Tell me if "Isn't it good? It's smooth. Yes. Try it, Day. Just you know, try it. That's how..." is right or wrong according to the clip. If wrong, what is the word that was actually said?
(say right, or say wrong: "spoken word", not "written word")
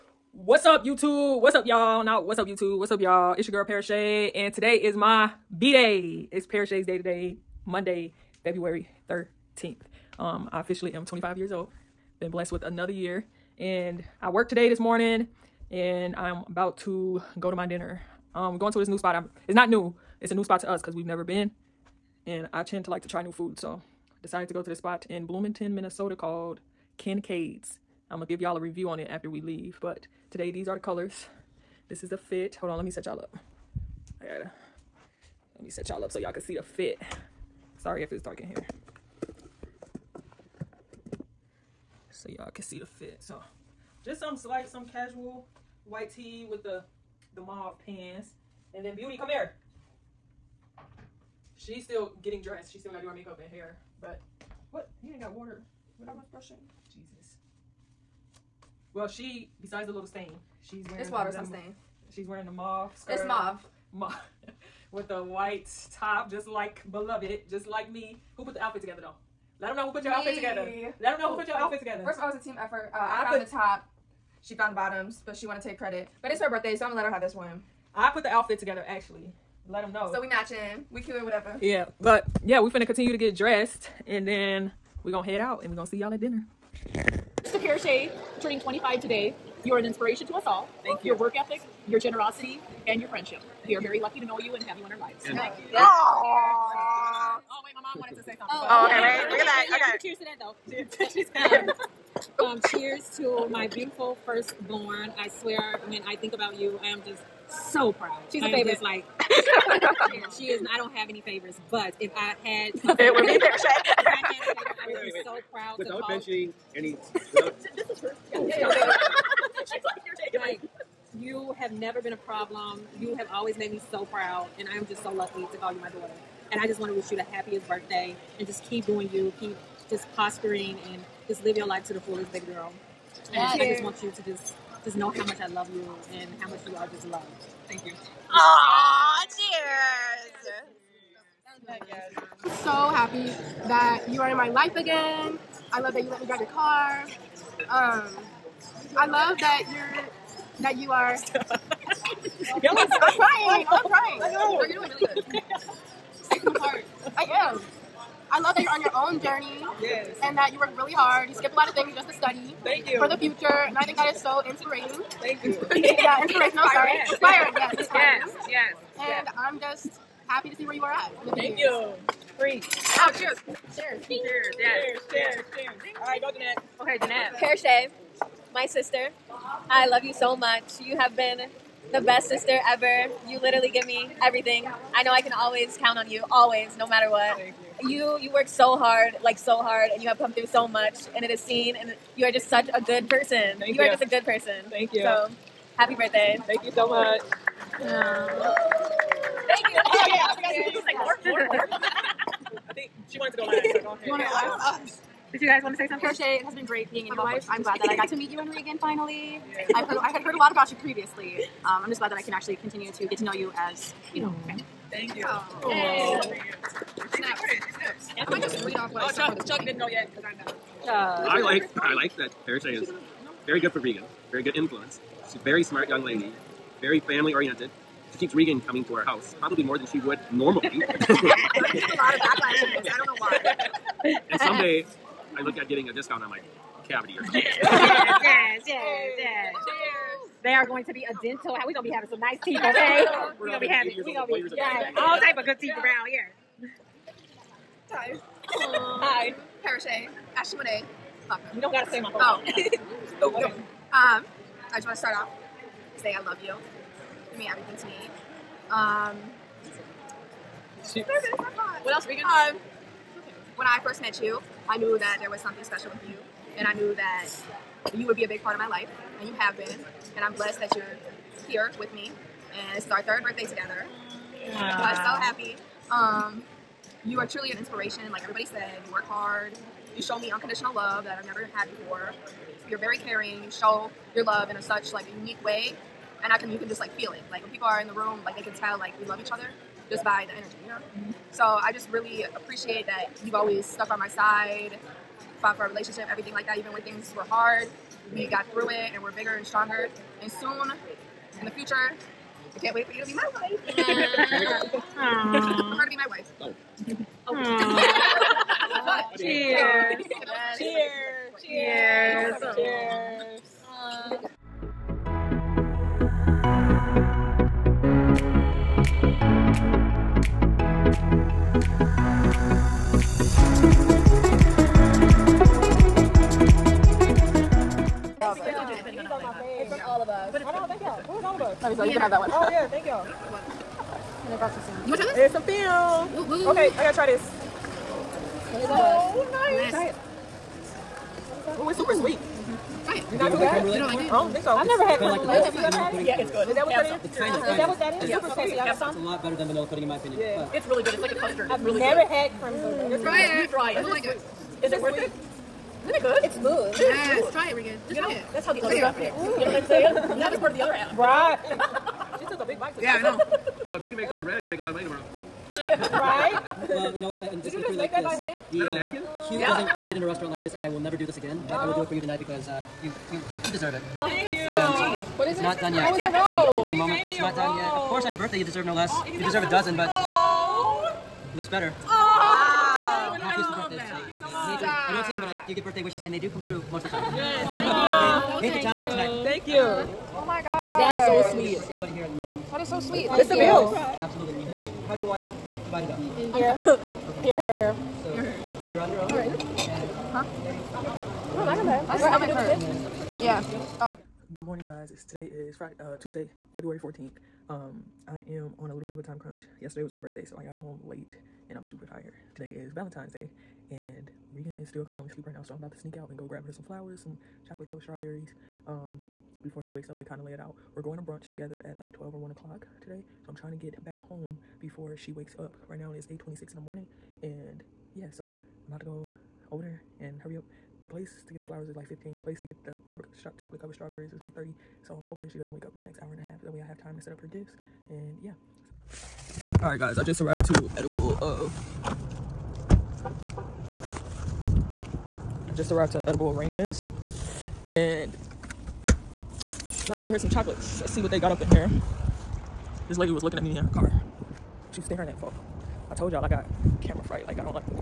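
wrong: "Regan", not "Day".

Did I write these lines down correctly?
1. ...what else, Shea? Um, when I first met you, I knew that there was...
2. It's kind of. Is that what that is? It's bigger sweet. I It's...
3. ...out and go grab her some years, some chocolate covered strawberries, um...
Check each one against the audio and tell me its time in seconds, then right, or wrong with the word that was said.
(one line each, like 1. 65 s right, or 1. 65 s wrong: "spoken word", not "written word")
1. 261 s wrong: "Regan", not "Shea"
2. 347 s wrong: "super", not "bigger"
3. 415 s wrong: "flowers", not "years".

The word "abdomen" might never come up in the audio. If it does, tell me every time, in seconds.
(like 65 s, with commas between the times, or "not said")
not said.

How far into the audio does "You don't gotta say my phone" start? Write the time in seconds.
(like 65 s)
251 s.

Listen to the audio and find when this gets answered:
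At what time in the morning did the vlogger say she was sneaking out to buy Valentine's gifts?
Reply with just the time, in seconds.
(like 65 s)
426 s.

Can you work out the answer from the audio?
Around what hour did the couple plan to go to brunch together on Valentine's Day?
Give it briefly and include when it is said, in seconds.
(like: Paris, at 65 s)
12 or 1, at 421 s.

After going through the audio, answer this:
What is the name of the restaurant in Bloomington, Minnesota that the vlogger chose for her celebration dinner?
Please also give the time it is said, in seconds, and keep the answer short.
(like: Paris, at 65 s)
Kincaid's, at 26 s.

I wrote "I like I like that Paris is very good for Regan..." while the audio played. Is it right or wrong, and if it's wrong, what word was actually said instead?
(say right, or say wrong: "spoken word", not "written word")
right.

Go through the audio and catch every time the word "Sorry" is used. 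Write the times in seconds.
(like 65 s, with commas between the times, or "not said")
37 s, 166 s.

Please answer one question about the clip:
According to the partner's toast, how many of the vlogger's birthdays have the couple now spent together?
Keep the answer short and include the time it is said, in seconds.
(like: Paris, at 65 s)
3, at 273 s.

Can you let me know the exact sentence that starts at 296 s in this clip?
Even when things were hard, we got through it and we're bigger and stronger.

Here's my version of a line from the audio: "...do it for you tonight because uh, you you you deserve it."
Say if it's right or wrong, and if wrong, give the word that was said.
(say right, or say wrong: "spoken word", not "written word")
right.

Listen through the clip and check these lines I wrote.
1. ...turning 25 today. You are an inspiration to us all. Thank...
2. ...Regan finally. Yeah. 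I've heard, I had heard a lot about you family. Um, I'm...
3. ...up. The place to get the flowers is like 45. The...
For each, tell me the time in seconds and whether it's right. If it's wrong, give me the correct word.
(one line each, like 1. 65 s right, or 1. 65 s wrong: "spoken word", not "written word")
1. 88 s right
2. 208 s wrong: "previously", not "family"
3. 430 s wrong: "15", not "45".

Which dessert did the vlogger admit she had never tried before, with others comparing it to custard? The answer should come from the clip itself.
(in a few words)
Creme brulee.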